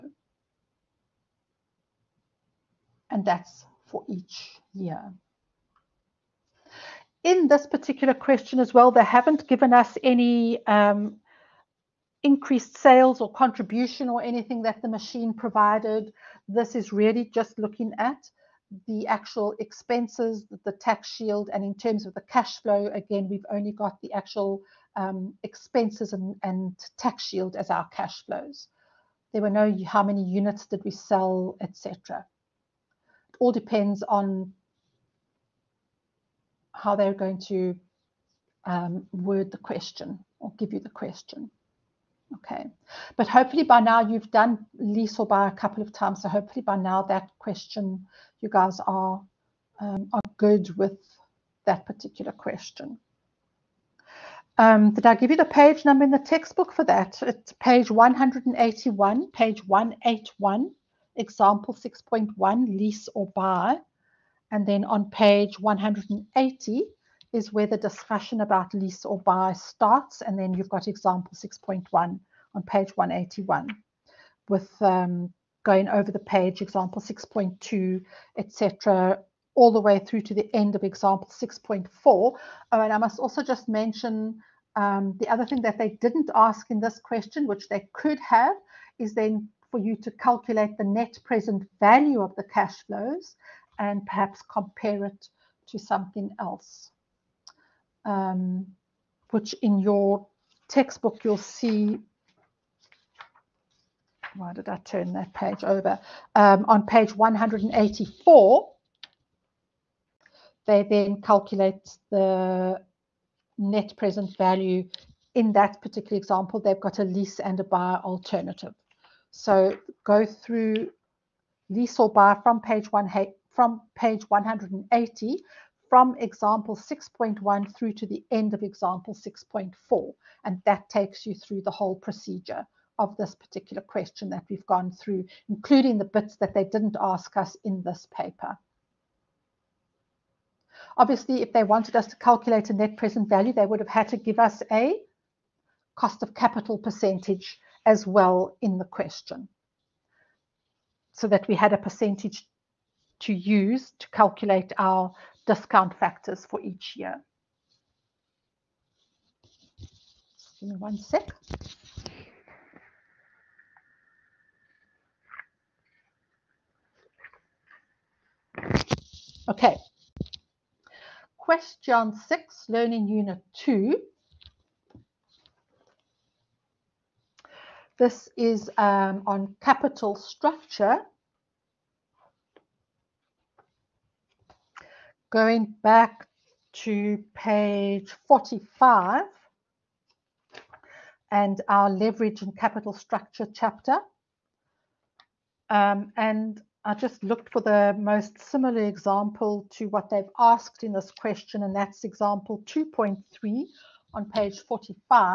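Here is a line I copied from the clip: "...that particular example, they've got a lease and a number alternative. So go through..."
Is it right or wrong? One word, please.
wrong.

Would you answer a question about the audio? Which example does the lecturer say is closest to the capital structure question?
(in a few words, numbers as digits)
Example 2.3.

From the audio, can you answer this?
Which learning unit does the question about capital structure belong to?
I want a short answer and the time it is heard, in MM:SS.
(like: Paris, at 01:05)
Learning unit two, at 02:52.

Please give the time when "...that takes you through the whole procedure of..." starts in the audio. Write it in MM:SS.
02:10.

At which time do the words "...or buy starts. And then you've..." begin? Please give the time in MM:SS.
01:09.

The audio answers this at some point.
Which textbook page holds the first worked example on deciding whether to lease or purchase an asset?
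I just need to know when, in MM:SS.
00:57.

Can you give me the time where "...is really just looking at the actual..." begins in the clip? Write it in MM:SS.
00:16.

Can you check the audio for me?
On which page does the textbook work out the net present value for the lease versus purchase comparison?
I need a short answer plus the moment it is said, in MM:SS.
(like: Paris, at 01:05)
184, at 01:46.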